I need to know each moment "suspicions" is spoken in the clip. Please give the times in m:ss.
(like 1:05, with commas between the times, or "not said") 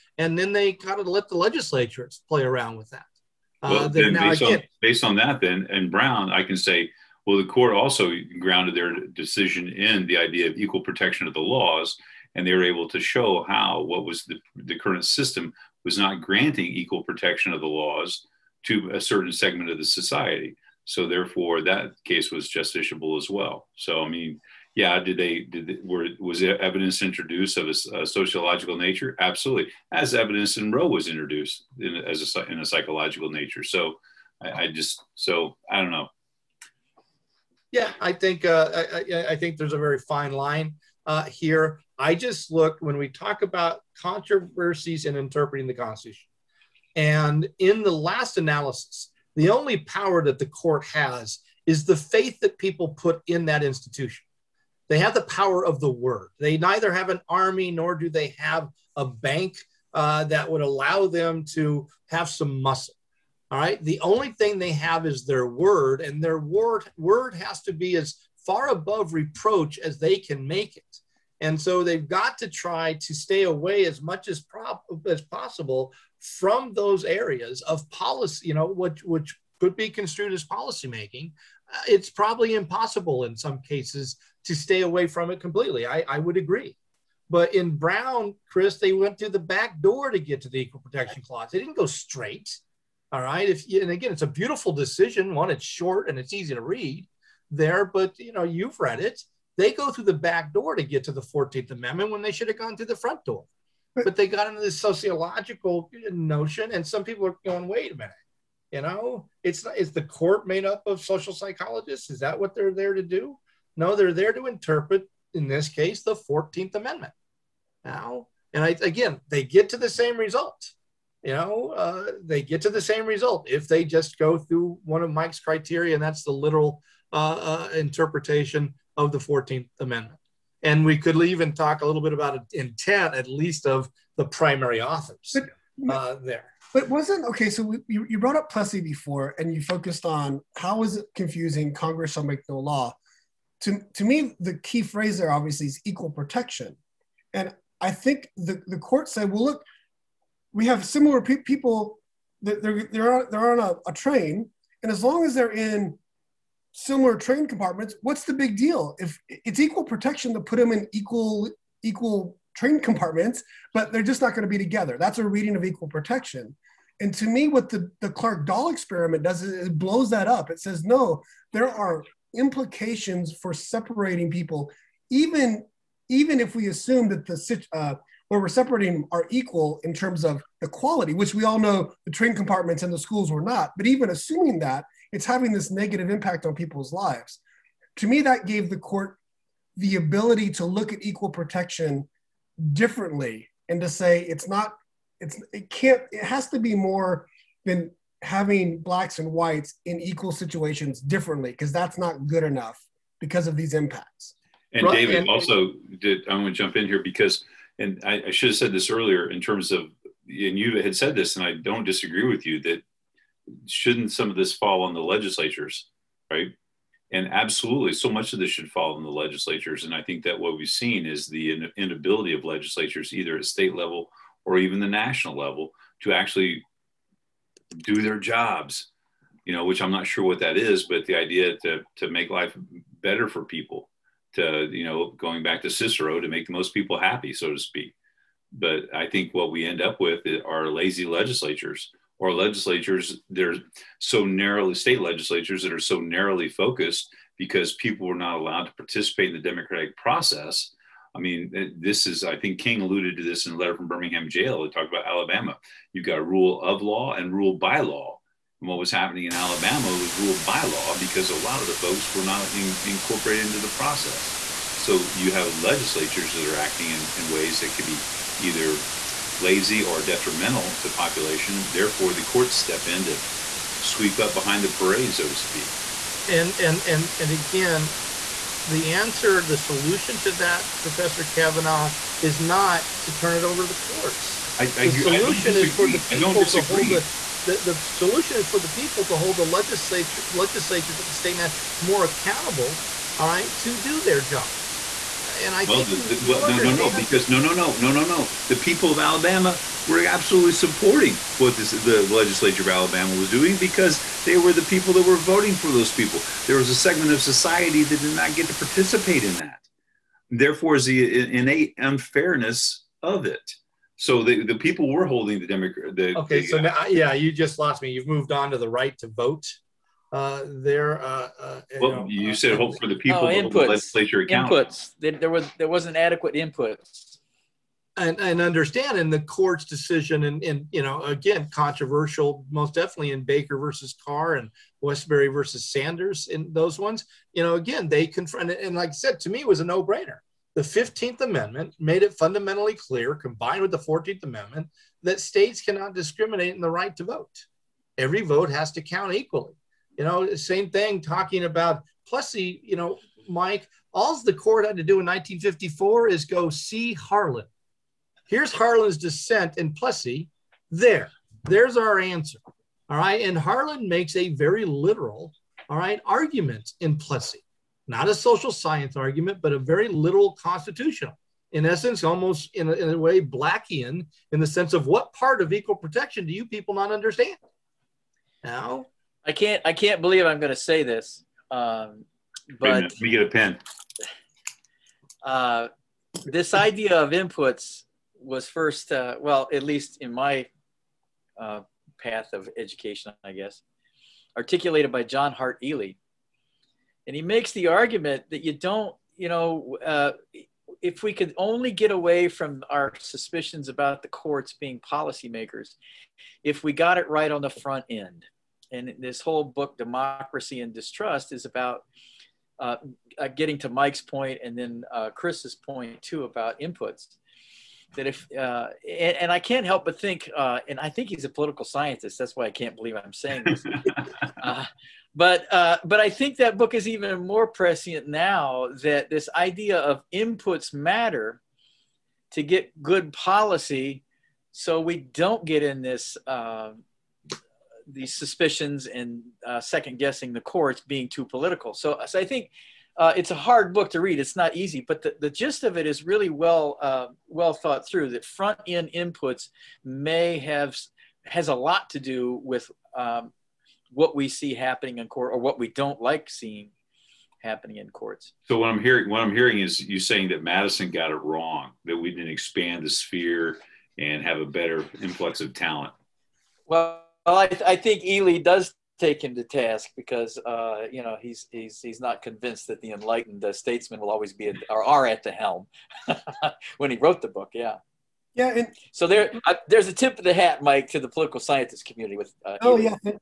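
6:42, 7:18.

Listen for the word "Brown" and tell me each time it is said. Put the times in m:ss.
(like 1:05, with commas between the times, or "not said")
0:05, 1:27.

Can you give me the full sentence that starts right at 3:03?
But even assuming that, it's having this negative impact on people's lives.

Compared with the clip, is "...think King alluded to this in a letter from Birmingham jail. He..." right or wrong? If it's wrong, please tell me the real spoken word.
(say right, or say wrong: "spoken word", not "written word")
right.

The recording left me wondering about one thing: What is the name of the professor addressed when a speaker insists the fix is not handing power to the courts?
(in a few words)
Professor Kavanaugh.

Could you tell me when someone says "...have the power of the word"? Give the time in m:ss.
0:54.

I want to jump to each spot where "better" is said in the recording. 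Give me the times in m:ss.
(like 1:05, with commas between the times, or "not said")
3:53, 7:44.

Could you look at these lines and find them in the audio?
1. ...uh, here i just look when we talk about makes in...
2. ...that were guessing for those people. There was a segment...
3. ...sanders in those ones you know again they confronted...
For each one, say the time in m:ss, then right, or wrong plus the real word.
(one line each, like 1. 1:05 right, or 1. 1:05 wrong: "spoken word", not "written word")
1. 0:41 wrong: "controversies", not "makes"
2. 5:04 wrong: "voting", not "guessing"
3. 5:35 right.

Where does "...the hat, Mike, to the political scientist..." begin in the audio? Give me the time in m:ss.
8:00.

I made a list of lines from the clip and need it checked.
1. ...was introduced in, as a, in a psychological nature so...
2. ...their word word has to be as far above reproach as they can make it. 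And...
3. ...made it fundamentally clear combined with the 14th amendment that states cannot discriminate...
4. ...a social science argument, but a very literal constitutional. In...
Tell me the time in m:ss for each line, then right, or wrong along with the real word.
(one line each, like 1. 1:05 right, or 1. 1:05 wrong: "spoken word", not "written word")
1. 0:30 right
2. 1:06 right
3. 5:41 right
4. 6:08 right.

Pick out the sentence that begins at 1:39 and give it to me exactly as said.
They go through the back door to get to the 14th Amendment when they should have gone through the front door.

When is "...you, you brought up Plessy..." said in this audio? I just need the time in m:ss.
2:17.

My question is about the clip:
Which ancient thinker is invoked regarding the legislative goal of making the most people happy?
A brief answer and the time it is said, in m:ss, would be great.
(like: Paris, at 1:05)
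Cicero, at 3:55.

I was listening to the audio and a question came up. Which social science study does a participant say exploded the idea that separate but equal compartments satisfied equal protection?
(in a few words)
Clark Doll experiment.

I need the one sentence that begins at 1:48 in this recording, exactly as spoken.
You know, it's not is the court made up of social psychologists?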